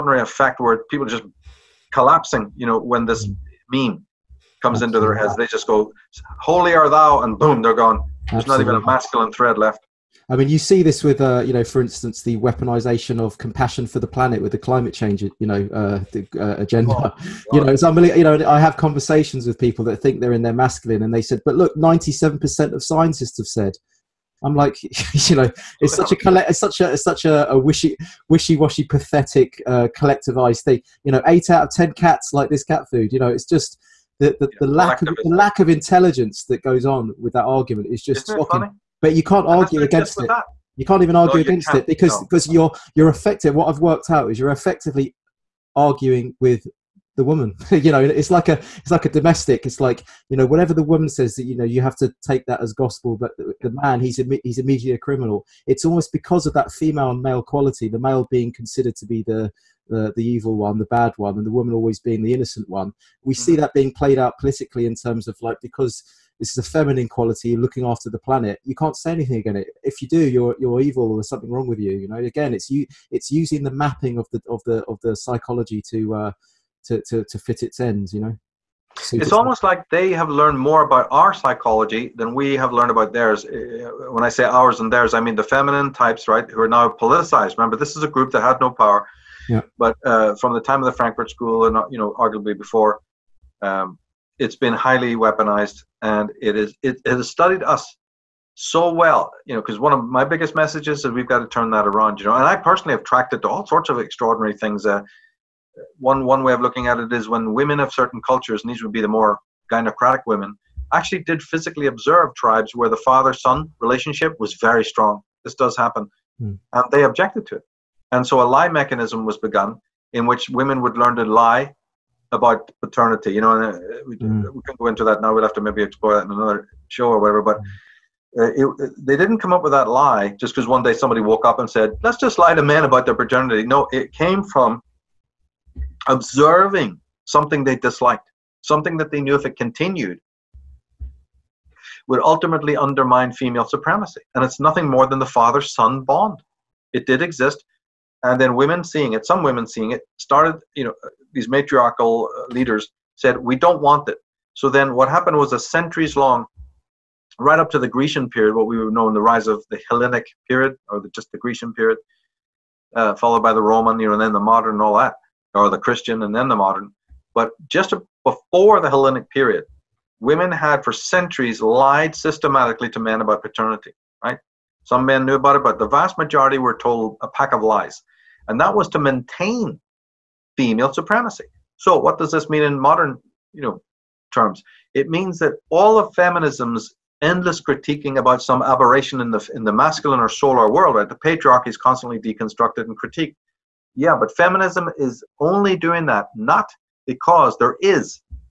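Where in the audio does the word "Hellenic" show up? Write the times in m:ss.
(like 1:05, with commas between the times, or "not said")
2:39, 2:48.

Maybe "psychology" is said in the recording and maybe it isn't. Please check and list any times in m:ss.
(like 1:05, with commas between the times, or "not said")
1:15, 1:21.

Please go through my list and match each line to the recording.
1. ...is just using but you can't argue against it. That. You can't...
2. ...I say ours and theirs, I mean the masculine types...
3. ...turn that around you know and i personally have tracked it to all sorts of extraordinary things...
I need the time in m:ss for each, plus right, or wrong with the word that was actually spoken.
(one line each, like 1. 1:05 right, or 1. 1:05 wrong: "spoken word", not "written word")
1. 0:37 wrong: "shocking", not "using"
2. 1:24 wrong: "feminine", not "masculine"
3. 1:41 right.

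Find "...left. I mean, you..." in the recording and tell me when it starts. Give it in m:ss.
0:09.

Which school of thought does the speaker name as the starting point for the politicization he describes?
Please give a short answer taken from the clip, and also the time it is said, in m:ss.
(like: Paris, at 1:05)
Frankfurt School, at 1:30.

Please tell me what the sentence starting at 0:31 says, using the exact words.
You know, eight out of ten cats like this cat food.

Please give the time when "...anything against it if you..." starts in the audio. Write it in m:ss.
1:09.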